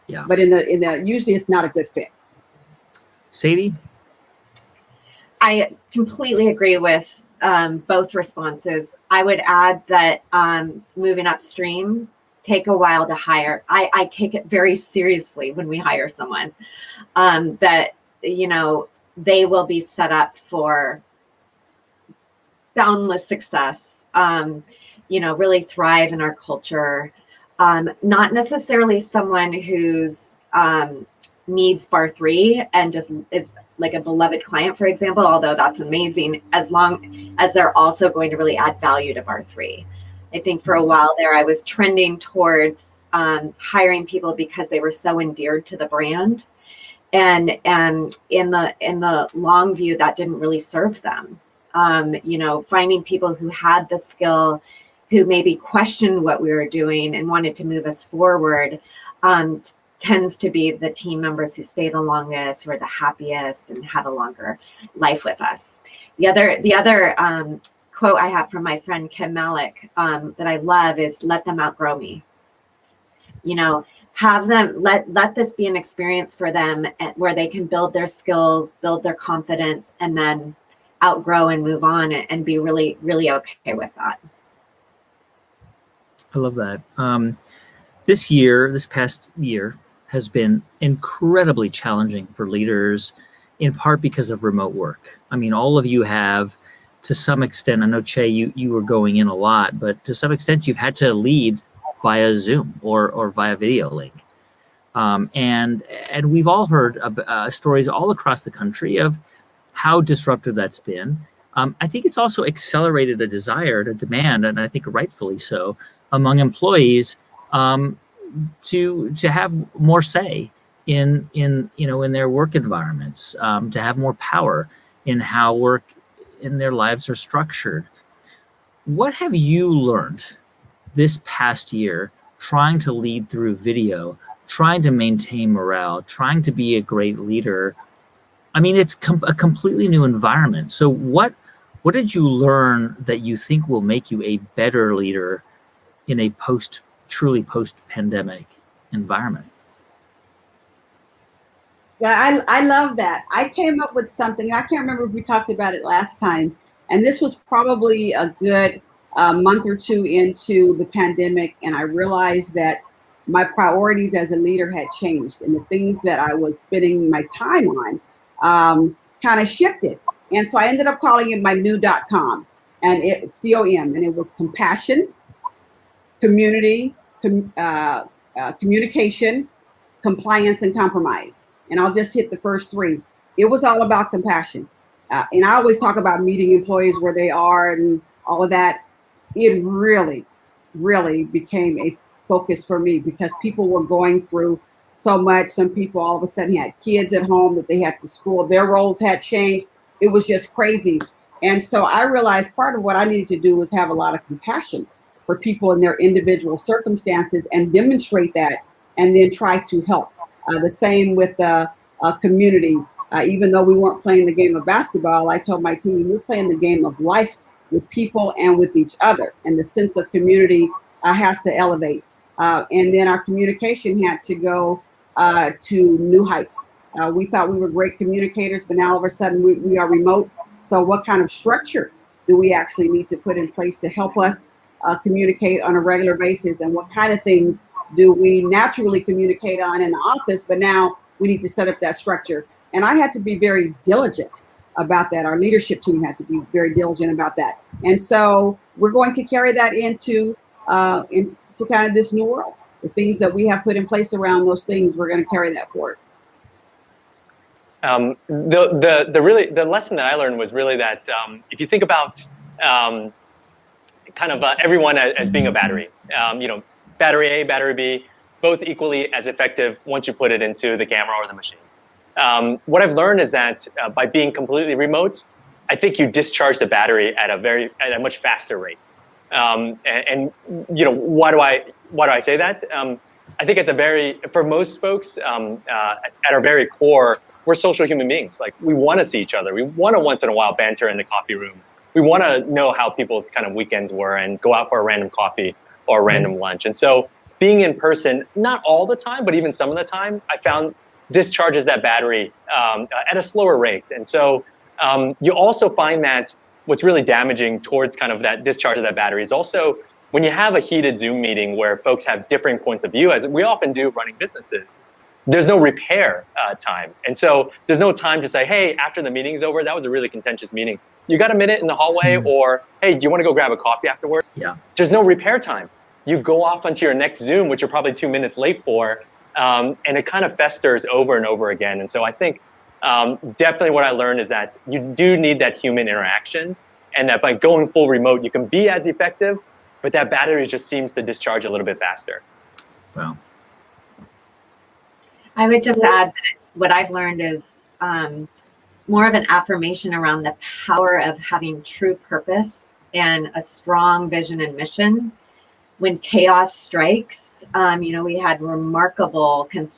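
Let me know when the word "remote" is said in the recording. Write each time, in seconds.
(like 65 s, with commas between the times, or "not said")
94 s, 229 s, 274 s, 337 s.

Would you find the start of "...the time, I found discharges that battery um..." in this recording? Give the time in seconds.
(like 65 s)
299 s.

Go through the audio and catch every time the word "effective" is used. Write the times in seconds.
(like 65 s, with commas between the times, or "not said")
269 s, 338 s.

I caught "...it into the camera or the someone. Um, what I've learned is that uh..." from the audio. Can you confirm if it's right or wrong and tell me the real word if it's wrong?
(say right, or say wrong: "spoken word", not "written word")
wrong: "machine", not "someone".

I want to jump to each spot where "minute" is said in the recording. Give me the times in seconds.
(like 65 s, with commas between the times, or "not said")
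321 s, 328 s.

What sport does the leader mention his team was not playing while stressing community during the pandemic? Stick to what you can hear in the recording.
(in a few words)
basketball.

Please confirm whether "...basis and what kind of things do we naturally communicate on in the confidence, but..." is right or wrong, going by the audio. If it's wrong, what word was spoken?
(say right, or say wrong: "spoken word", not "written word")
wrong: "office", not "confidence".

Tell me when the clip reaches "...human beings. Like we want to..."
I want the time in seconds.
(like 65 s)
287 s.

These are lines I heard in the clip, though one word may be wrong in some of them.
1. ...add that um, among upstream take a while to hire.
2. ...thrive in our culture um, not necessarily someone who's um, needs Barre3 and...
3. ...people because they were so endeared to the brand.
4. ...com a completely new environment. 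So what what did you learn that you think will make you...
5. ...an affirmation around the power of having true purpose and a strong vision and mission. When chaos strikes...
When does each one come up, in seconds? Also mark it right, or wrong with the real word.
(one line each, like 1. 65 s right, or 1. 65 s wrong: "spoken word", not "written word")
1. 9 s wrong: "moving", not "among"
2. 25 s right
3. 44 s right
4. 138 s right
5. 349 s right.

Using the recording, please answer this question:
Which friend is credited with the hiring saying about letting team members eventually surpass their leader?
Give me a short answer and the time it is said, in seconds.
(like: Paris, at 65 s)
Kim Malik, at 69 s.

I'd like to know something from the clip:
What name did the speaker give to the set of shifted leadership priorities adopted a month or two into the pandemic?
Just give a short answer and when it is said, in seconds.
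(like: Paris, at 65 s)
new.com, at 171 s.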